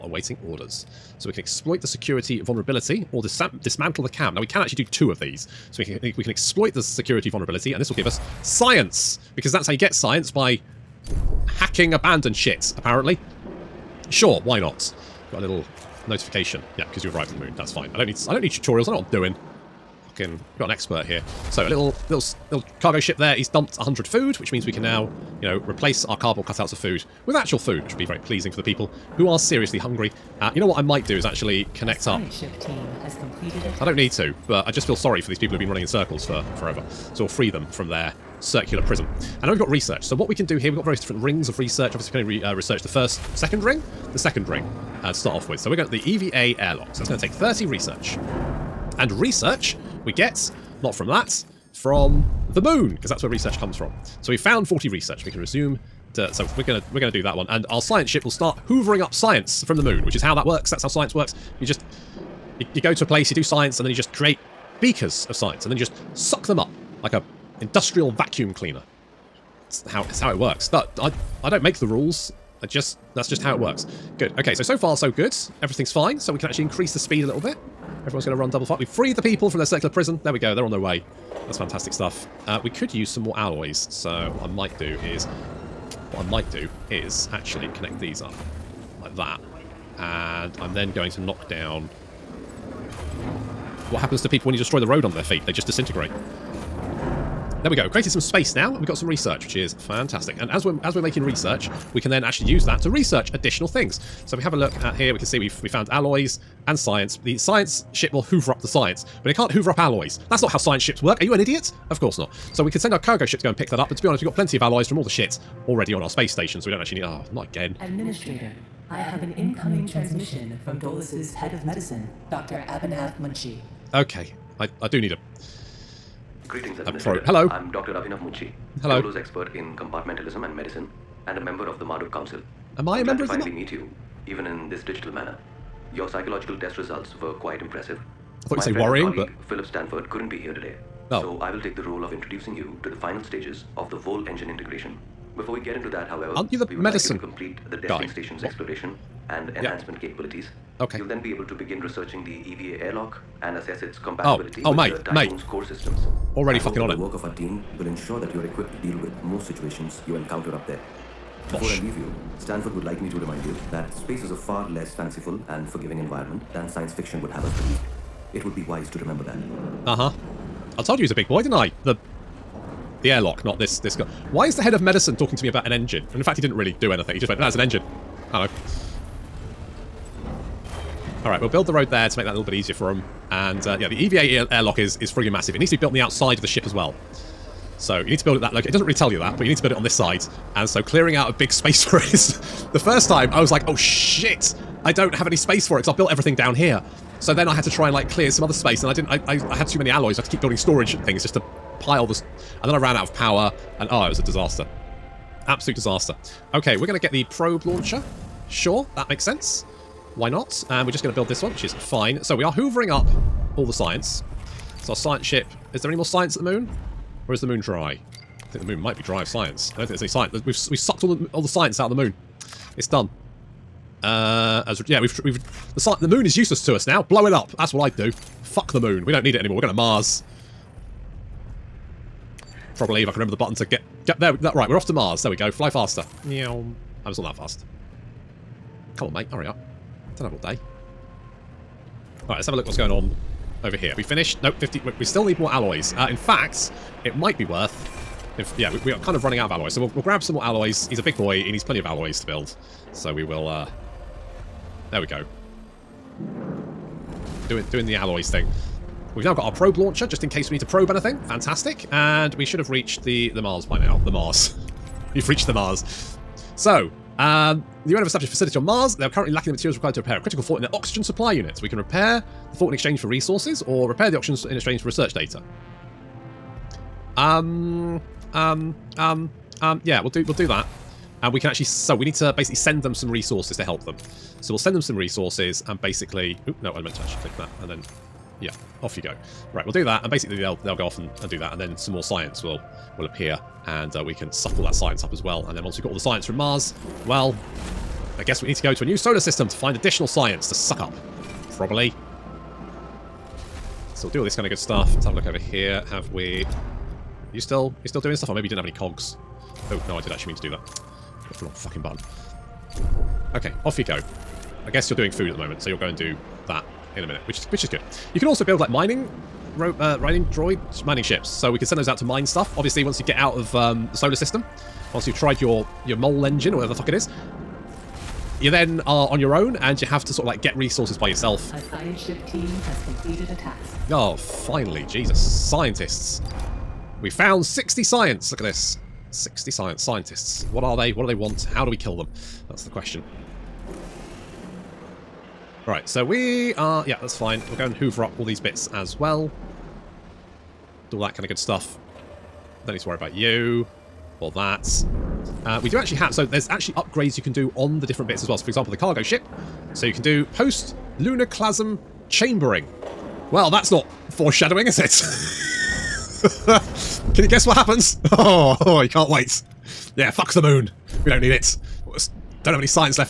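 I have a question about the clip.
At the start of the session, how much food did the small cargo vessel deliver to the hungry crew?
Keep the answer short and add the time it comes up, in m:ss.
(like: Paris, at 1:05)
100, at 0:23.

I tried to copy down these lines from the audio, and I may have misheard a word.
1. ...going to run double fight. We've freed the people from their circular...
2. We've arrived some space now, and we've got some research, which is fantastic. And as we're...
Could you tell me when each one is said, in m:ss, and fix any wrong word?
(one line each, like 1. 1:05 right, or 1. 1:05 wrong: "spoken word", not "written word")
1. 1:18 right
2. 1:37 wrong: "created", not "arrived".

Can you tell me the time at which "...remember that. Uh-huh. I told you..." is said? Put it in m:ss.
2:48.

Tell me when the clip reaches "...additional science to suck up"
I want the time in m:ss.
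4:59.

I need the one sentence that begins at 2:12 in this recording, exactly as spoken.
Am I I'm a member of the...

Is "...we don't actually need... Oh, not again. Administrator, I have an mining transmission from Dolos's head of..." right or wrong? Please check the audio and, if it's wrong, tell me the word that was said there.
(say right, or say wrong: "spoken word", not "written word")
wrong: "incoming", not "mining".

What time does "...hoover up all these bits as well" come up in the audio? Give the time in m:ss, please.
5:47.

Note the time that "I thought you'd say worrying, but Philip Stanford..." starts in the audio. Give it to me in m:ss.
2:18.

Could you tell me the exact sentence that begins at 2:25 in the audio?
Before we get into that, however, Aren't you the we would medicine like you to complete the testing guy.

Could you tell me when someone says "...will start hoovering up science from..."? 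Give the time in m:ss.
0:58.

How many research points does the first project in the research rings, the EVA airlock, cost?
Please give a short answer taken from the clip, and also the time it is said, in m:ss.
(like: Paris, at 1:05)
30, at 0:47.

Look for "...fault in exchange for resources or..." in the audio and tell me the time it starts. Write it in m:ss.
4:32.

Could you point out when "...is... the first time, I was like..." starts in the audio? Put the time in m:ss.
3:12.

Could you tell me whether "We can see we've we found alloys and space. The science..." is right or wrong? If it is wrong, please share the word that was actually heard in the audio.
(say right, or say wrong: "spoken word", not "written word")
wrong: "science", not "space".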